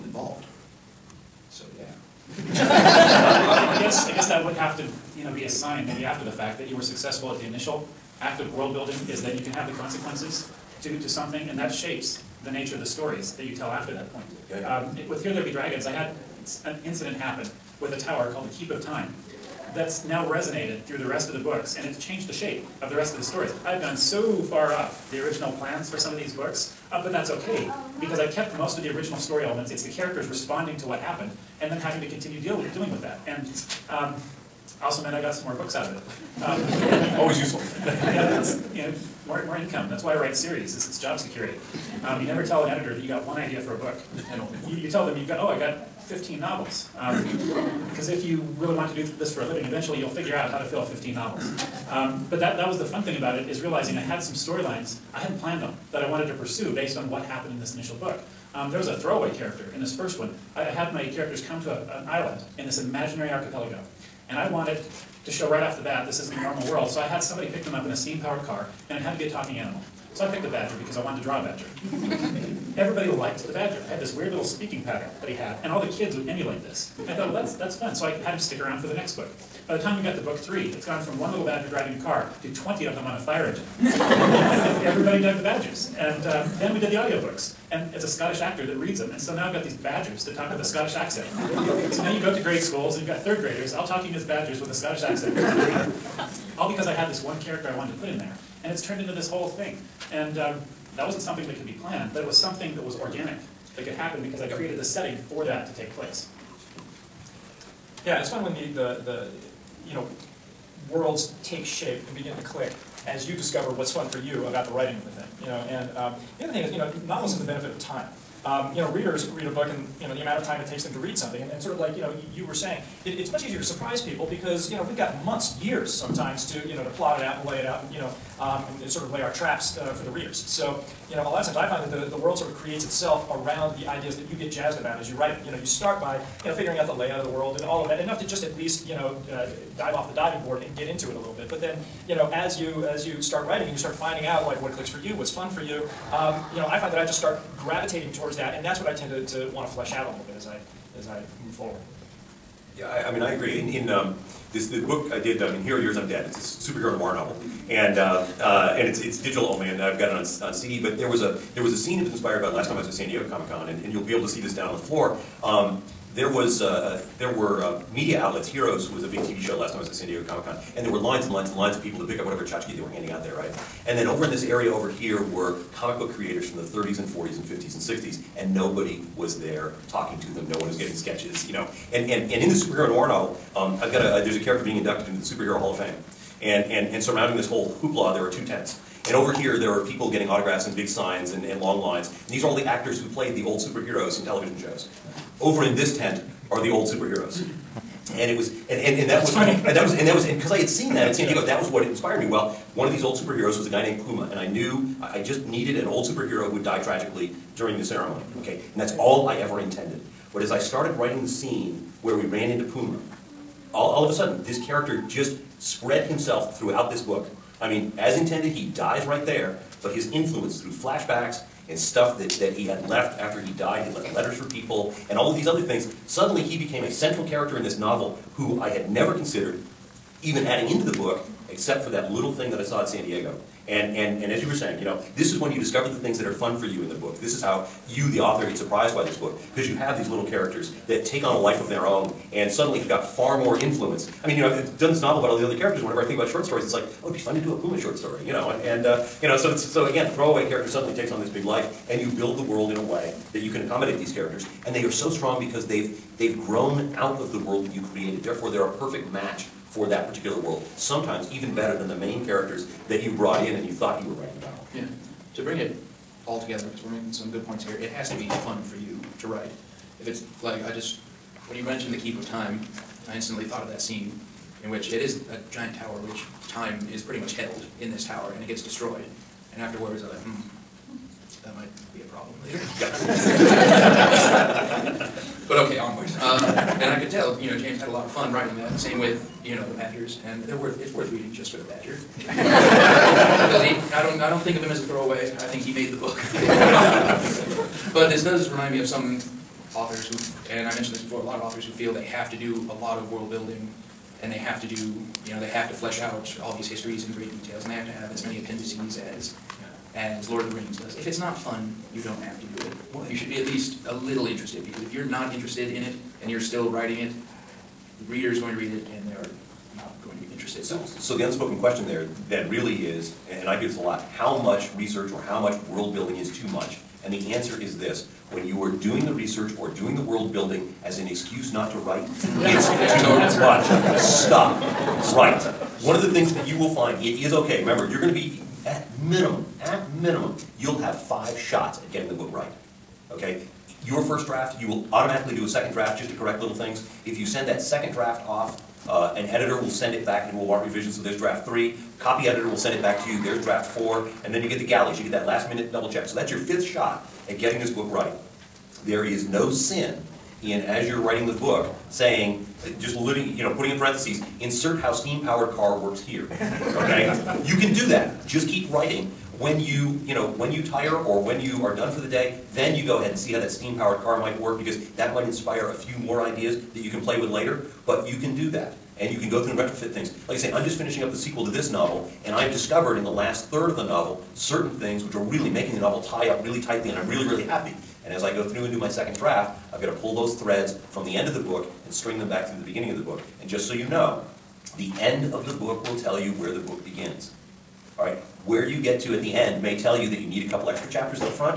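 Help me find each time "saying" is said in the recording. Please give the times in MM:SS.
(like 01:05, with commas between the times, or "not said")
02:02, 03:54, 06:01.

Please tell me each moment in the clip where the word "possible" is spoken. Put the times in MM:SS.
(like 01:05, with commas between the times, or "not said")
not said.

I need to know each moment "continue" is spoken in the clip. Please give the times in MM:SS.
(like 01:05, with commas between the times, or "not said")
00:32.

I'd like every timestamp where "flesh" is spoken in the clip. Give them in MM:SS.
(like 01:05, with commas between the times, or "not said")
02:29, 05:05.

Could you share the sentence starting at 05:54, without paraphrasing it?
You get that last minute double check.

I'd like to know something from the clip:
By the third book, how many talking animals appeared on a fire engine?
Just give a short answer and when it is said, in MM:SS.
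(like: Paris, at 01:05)
20, at 01:22.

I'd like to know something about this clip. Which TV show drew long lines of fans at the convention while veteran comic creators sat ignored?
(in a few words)
Heroes.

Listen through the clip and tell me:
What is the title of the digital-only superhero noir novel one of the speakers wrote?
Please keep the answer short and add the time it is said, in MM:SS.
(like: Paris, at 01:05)
Hero Years I'm Dead, at 02:35.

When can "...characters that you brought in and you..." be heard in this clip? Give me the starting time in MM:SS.
04:22.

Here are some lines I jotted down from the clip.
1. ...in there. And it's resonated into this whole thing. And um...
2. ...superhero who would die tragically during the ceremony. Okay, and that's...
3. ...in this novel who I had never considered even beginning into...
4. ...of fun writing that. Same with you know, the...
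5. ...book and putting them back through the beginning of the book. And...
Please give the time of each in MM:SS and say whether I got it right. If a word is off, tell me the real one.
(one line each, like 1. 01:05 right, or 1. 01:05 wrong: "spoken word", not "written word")
1. 01:38 wrong: "turned", not "resonated"
2. 03:26 right
3. 03:47 wrong: "adding", not "beginning"
4. 04:48 right
5. 06:31 wrong: "string", not "putting".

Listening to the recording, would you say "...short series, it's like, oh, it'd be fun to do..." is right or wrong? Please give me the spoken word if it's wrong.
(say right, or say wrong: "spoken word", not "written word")
wrong: "stories", not "series".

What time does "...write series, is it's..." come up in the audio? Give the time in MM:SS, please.
00:40.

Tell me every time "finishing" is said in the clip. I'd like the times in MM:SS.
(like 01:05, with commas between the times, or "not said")
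06:20.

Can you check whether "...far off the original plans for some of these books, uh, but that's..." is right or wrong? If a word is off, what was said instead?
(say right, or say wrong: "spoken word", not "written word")
right.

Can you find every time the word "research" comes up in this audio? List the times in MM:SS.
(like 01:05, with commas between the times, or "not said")
05:24, 05:29.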